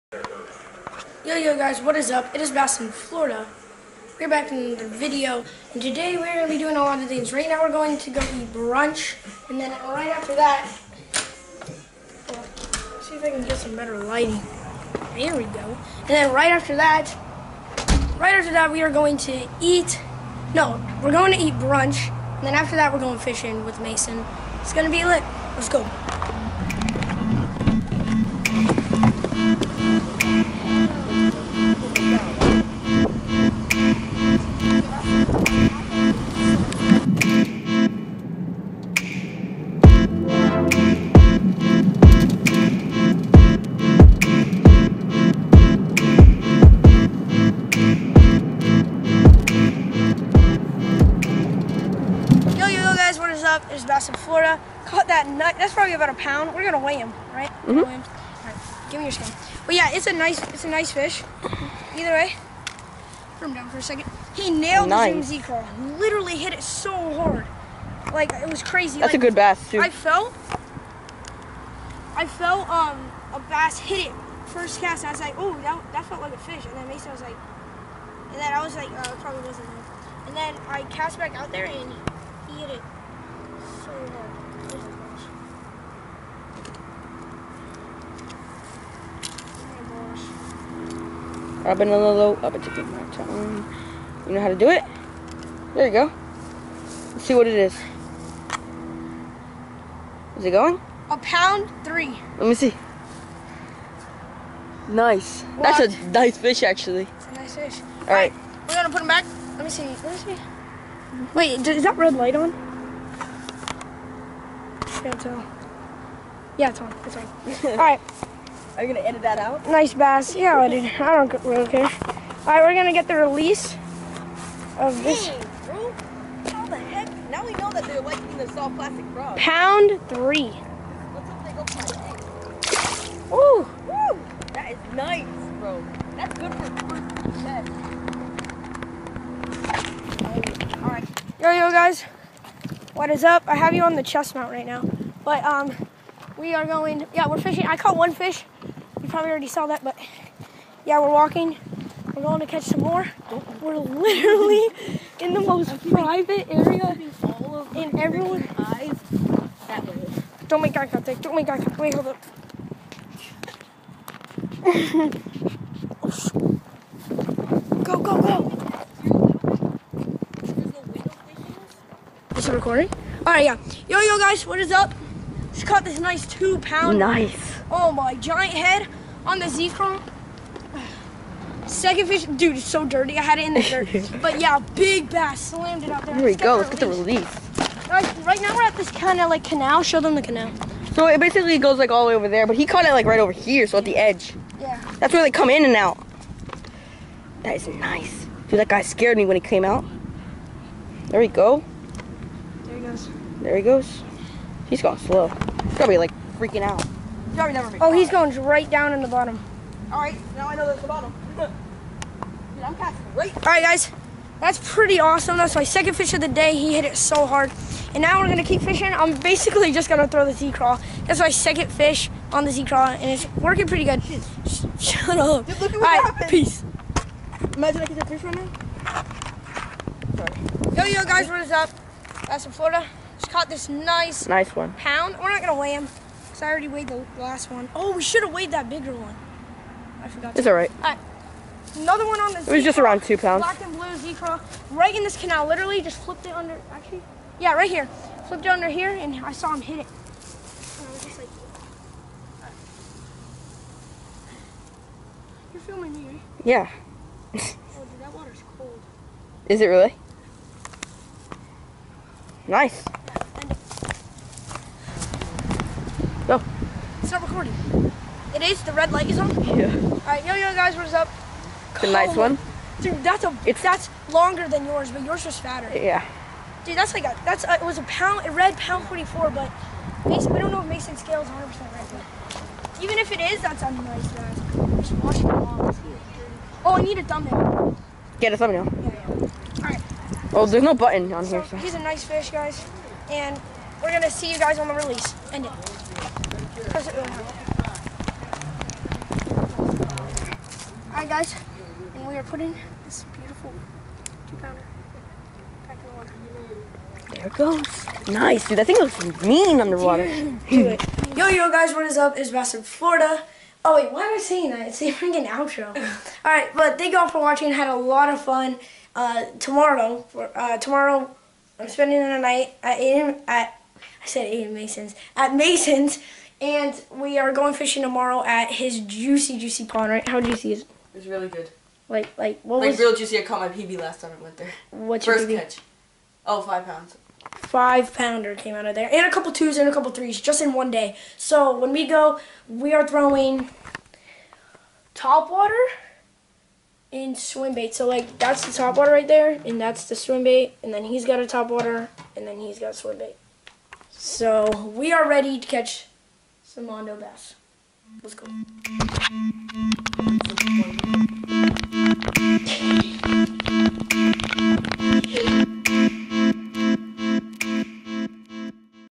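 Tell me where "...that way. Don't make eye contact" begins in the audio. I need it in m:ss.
2:39.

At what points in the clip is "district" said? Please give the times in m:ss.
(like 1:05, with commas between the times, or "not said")
not said.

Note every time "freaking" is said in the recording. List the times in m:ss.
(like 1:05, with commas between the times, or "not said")
3:26, 5:14.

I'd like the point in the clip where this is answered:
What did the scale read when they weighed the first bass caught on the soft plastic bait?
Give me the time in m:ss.
1:41.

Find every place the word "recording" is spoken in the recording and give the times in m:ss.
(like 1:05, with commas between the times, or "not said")
2:52, 4:27.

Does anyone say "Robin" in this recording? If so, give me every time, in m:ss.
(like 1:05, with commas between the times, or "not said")
1:31.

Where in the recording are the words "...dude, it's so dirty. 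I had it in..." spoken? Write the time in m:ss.
3:02.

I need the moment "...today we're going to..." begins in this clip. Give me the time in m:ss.
0:05.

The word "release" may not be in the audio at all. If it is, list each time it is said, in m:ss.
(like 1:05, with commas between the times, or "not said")
2:03, 3:06, 4:54.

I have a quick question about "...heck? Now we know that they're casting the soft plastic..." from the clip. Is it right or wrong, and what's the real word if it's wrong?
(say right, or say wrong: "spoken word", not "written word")
wrong: "liking", not "casting".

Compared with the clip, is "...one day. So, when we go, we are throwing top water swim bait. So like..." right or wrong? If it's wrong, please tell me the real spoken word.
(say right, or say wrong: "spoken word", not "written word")
right.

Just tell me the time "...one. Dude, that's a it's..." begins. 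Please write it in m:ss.
4:32.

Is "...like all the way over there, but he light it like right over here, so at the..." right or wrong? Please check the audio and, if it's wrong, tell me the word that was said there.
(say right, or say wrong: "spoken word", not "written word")
wrong: "caught", not "light".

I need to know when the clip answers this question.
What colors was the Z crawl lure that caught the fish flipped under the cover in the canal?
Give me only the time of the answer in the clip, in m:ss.
4:03.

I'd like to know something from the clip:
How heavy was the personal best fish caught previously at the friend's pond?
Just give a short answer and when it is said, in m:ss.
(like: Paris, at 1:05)
5 pounds, at 5:36.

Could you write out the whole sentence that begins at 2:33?
We're literally in the most private area.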